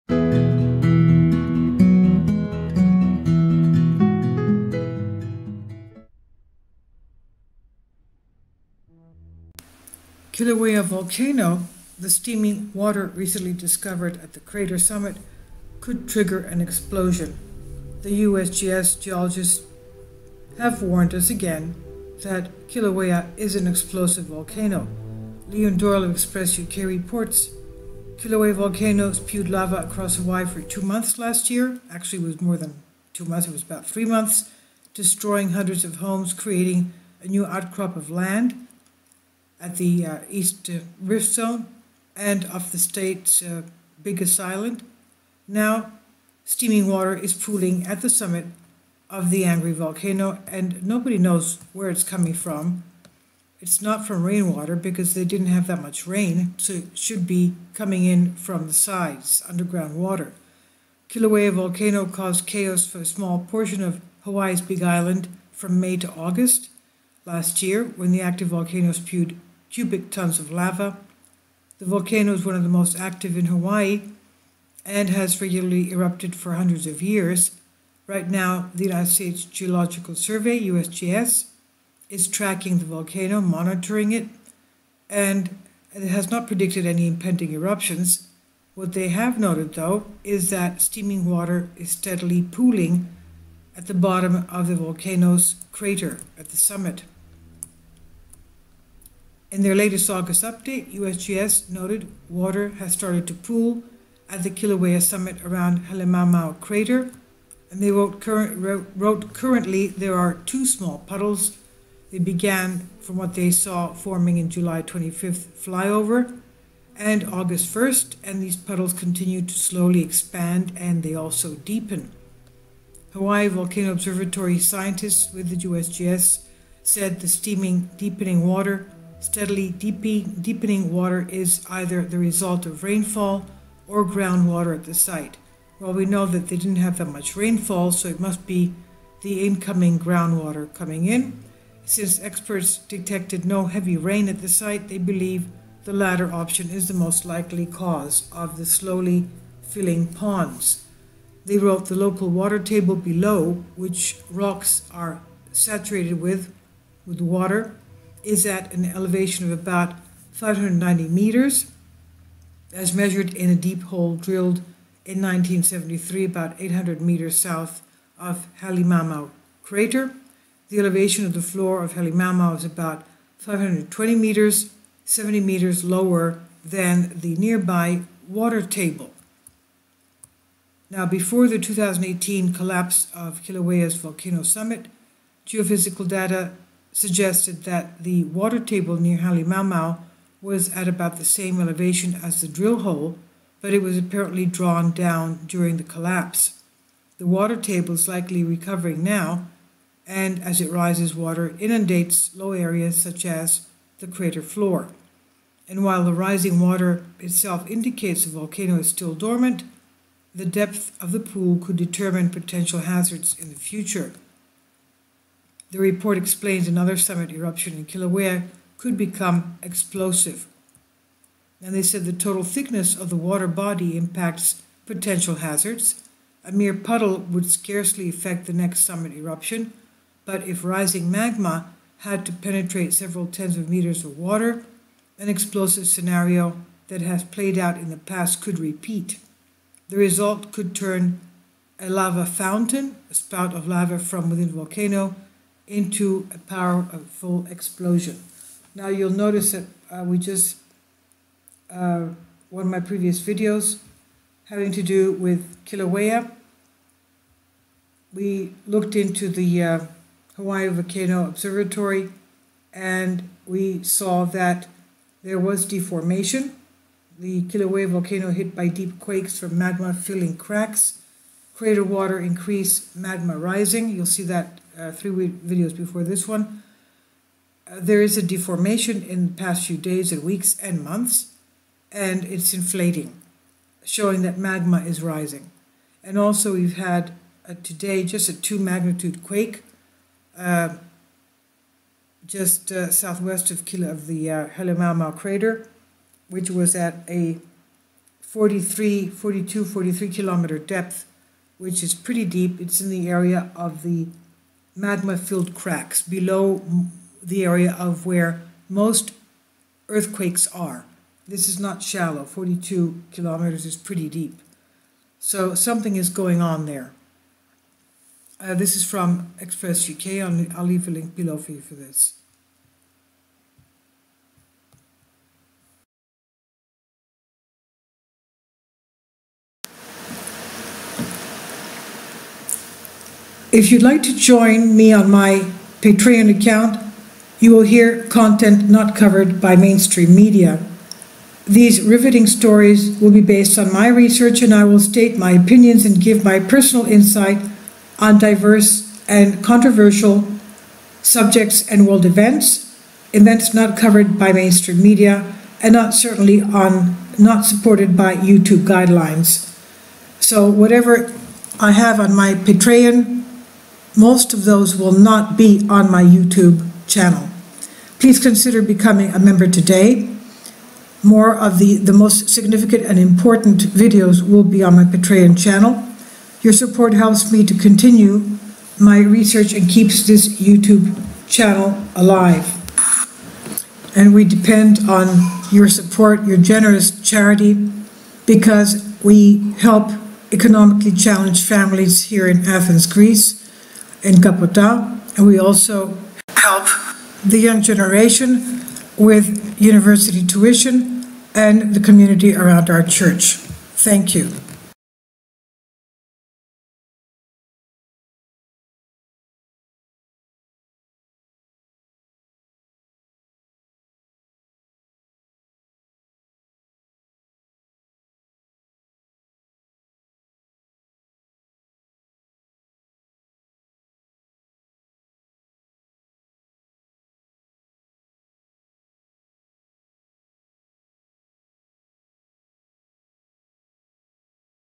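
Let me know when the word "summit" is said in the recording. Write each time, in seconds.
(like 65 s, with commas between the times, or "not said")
14 s, 48 s, 96 s, 105 s, 184 s, 216 s, 228 s.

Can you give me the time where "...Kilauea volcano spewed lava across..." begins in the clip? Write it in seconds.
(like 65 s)
28 s.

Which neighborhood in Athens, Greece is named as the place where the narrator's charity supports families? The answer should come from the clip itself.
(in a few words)
Capota.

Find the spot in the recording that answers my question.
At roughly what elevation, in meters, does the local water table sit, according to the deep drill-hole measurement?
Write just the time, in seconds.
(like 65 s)
160 s.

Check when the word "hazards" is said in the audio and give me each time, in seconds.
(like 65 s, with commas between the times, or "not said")
212 s, 225 s.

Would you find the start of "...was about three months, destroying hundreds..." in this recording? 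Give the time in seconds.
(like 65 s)
33 s.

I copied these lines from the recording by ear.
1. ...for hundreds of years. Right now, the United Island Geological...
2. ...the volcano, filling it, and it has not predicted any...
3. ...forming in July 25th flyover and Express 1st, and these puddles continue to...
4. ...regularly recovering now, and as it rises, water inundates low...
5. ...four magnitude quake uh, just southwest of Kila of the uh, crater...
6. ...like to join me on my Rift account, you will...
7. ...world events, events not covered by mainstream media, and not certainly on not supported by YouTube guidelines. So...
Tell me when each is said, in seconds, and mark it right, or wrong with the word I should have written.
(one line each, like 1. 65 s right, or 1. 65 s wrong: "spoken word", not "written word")
1. 76 s wrong: "States", not "Island"
2. 82 s wrong: "monitoring", not "filling"
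3. 113 s wrong: "August", not "Express"
4. 198 s wrong: "likely", not "regularly"
5. 288 s wrong: "two", not "four"
6. 333 s wrong: "Patreon", not "Rift"
7. 351 s right.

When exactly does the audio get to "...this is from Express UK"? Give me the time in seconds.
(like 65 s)
318 s.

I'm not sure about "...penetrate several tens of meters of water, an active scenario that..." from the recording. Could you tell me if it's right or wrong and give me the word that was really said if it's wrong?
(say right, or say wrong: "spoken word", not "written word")
wrong: "explosive", not "active".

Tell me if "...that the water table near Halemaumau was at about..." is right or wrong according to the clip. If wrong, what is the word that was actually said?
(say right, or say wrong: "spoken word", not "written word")
right.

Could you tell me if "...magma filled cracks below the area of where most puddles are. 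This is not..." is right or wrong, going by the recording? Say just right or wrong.
wrong.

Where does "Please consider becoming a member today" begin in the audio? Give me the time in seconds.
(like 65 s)
367 s.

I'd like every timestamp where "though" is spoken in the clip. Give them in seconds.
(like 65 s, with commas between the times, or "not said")
89 s.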